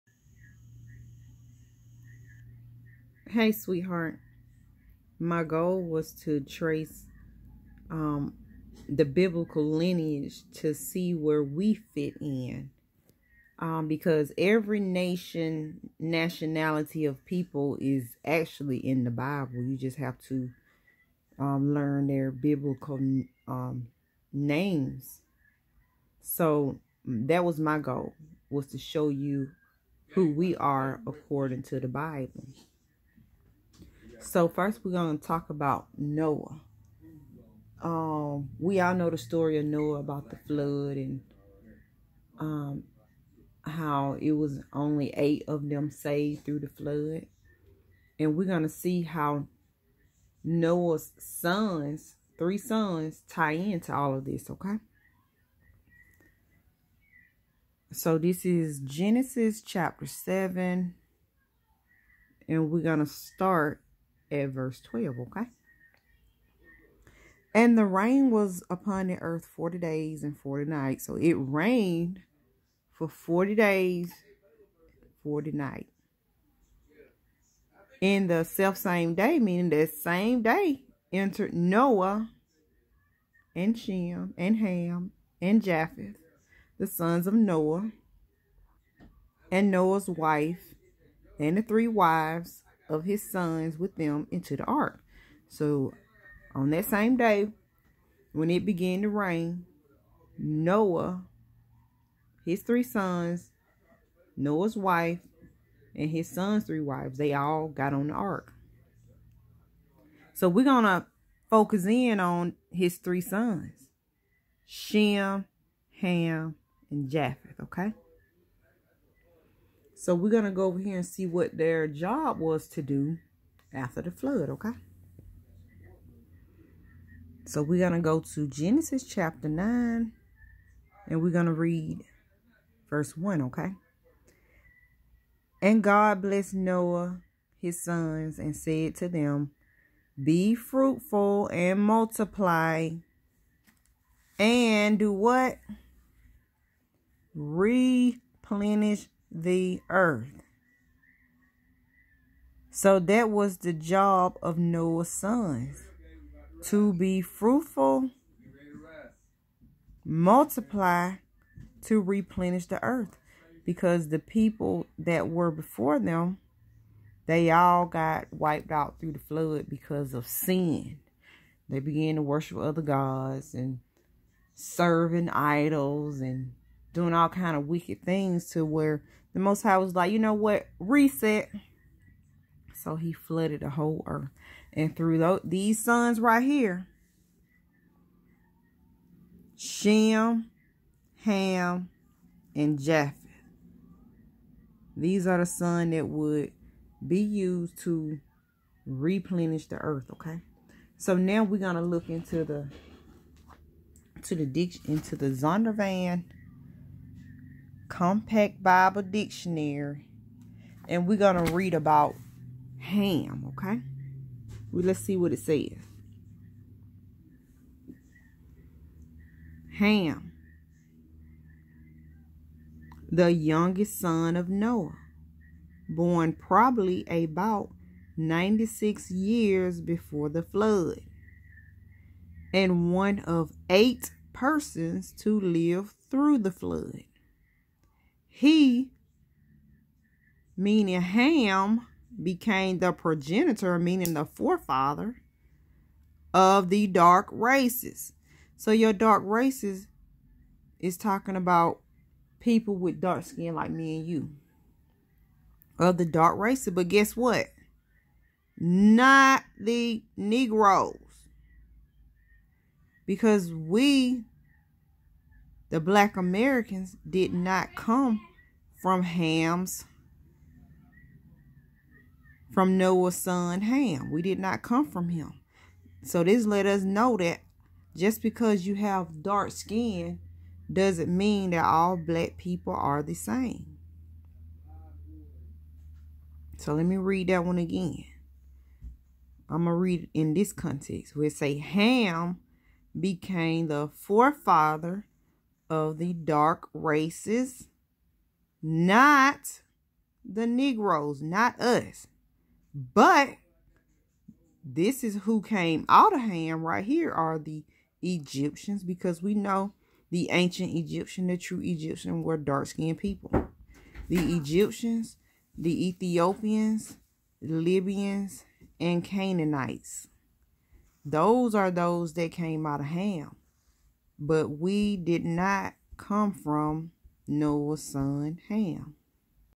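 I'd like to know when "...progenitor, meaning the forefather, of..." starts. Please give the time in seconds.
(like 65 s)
242 s.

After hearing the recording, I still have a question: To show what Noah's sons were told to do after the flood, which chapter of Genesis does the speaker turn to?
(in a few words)
Genesis chapter 9.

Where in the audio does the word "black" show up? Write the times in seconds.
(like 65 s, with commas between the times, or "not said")
265 s, 281 s.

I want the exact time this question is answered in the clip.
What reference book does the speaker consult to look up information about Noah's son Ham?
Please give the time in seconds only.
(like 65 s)
205 s.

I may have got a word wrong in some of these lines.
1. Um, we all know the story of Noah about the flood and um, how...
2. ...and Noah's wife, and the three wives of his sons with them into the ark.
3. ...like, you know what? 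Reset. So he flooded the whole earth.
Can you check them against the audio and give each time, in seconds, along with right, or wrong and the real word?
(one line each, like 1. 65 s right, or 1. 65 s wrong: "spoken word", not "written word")
1. 37 s right
2. 89 s right
3. 179 s right.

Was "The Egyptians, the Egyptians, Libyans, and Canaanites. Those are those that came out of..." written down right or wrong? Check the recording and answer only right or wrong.
wrong.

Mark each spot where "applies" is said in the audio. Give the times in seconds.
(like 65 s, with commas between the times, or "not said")
not said.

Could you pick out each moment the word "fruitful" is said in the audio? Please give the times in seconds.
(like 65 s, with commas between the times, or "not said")
140 s, 157 s.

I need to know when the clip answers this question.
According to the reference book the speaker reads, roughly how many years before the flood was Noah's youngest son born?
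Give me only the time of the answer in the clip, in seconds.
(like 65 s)
228 s.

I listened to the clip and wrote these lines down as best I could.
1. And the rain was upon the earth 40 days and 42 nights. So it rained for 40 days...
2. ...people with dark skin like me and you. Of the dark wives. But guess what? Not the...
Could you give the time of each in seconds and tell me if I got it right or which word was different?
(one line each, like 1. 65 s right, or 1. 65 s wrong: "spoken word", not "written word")
1. 67 s wrong: "40", not "42"
2. 252 s wrong: "races", not "wives".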